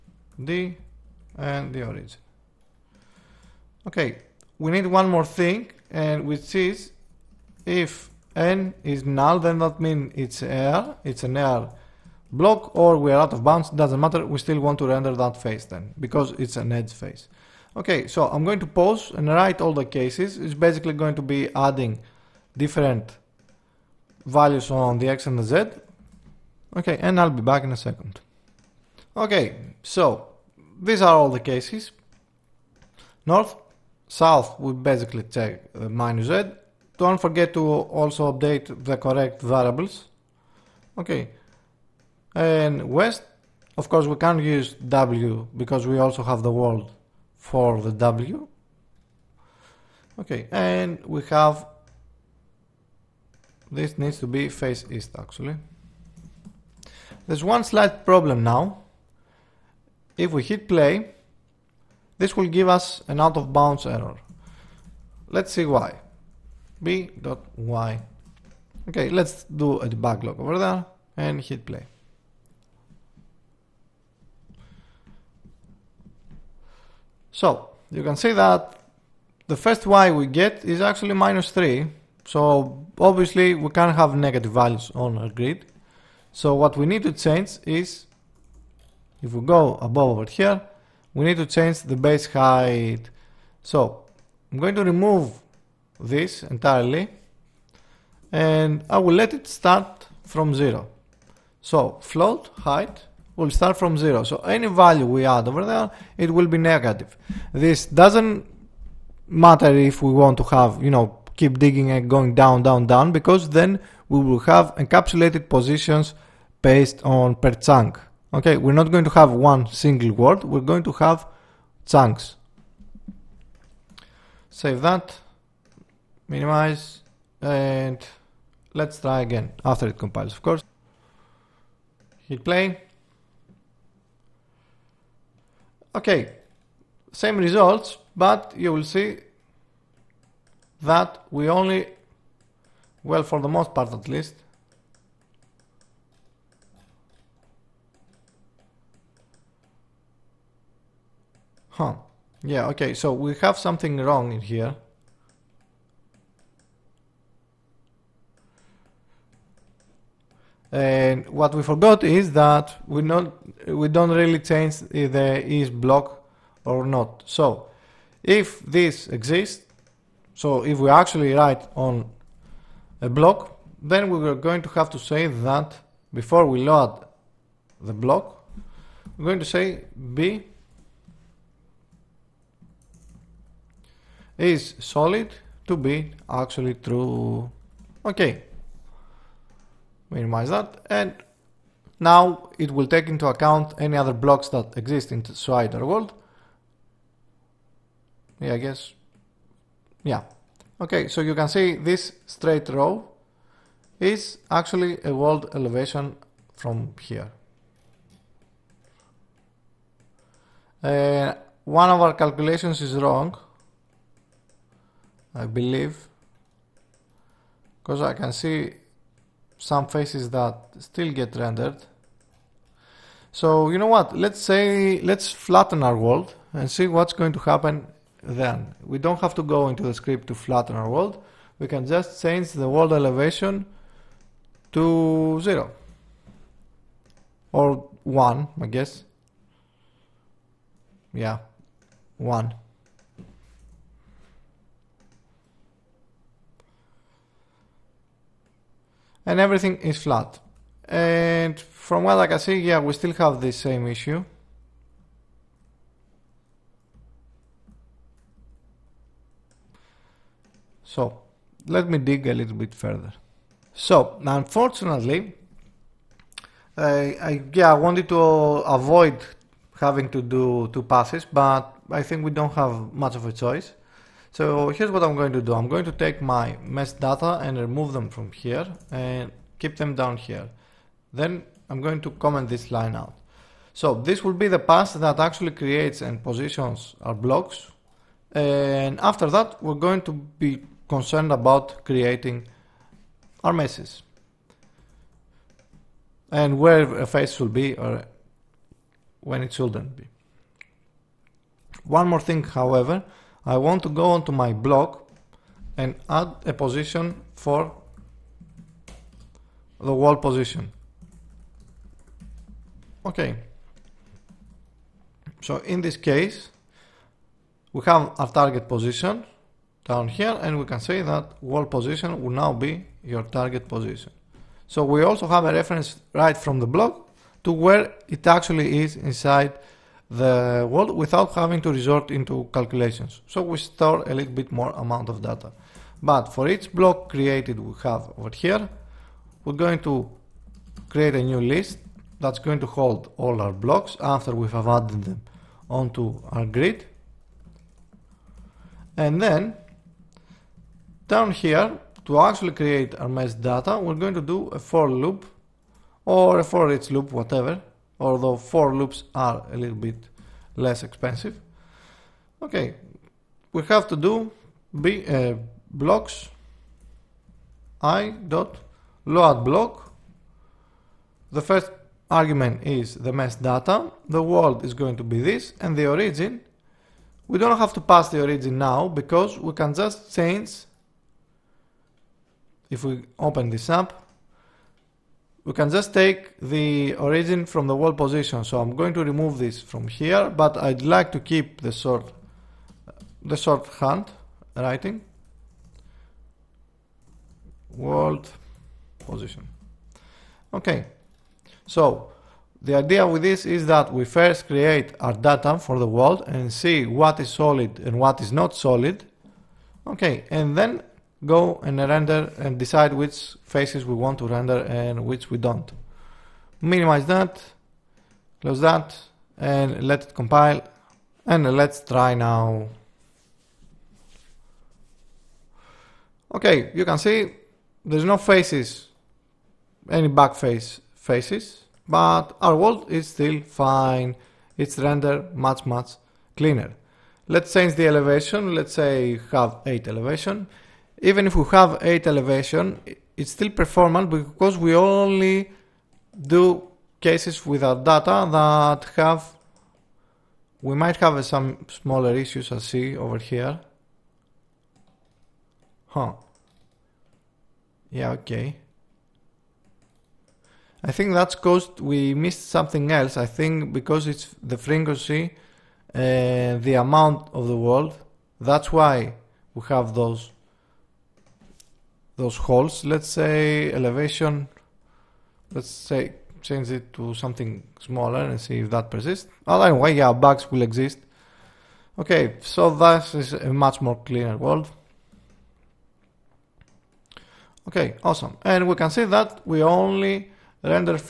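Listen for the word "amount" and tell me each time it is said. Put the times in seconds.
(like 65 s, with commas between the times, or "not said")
334 s, 466 s.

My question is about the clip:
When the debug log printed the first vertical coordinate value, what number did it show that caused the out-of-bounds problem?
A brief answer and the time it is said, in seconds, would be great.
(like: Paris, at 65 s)
-3, at 81 s.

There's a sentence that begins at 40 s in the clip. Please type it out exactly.
Okay, and west, of course we can't use w because we also have the world for the W.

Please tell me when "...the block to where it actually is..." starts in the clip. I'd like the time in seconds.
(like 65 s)
326 s.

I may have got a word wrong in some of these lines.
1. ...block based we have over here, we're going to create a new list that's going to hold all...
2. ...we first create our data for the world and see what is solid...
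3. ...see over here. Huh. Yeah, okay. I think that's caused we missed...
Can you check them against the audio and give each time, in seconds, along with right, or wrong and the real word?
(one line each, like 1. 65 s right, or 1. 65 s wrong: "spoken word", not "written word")
1. 336 s wrong: "created", not "based"
2. 403 s right
3. 452 s right.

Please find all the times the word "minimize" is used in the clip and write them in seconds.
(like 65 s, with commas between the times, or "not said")
126 s, 190 s, 416 s.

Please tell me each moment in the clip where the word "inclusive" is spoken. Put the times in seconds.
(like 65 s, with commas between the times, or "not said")
not said.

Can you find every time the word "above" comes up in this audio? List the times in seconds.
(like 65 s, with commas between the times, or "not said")
89 s.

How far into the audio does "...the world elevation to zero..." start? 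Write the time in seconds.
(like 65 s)
232 s.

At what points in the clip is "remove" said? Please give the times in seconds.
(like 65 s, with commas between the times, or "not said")
94 s, 277 s, 389 s.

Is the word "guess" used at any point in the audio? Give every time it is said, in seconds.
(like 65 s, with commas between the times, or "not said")
198 s, 238 s.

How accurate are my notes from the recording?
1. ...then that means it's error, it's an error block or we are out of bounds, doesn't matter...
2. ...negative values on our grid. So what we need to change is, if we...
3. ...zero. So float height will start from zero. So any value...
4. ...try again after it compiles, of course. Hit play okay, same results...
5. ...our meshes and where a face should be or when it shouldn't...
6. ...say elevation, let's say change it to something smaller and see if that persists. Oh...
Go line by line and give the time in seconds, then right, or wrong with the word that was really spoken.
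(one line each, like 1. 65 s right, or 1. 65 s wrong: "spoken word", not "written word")
1. 9 s right
2. 84 s right
3. 100 s right
4. 128 s right
5. 293 s right
6. 473 s right.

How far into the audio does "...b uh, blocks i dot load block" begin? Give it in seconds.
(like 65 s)
364 s.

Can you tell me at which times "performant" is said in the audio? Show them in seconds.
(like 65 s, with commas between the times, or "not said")
443 s.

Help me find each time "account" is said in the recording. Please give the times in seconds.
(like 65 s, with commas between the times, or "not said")
193 s.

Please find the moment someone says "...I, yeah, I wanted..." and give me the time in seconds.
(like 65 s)
267 s.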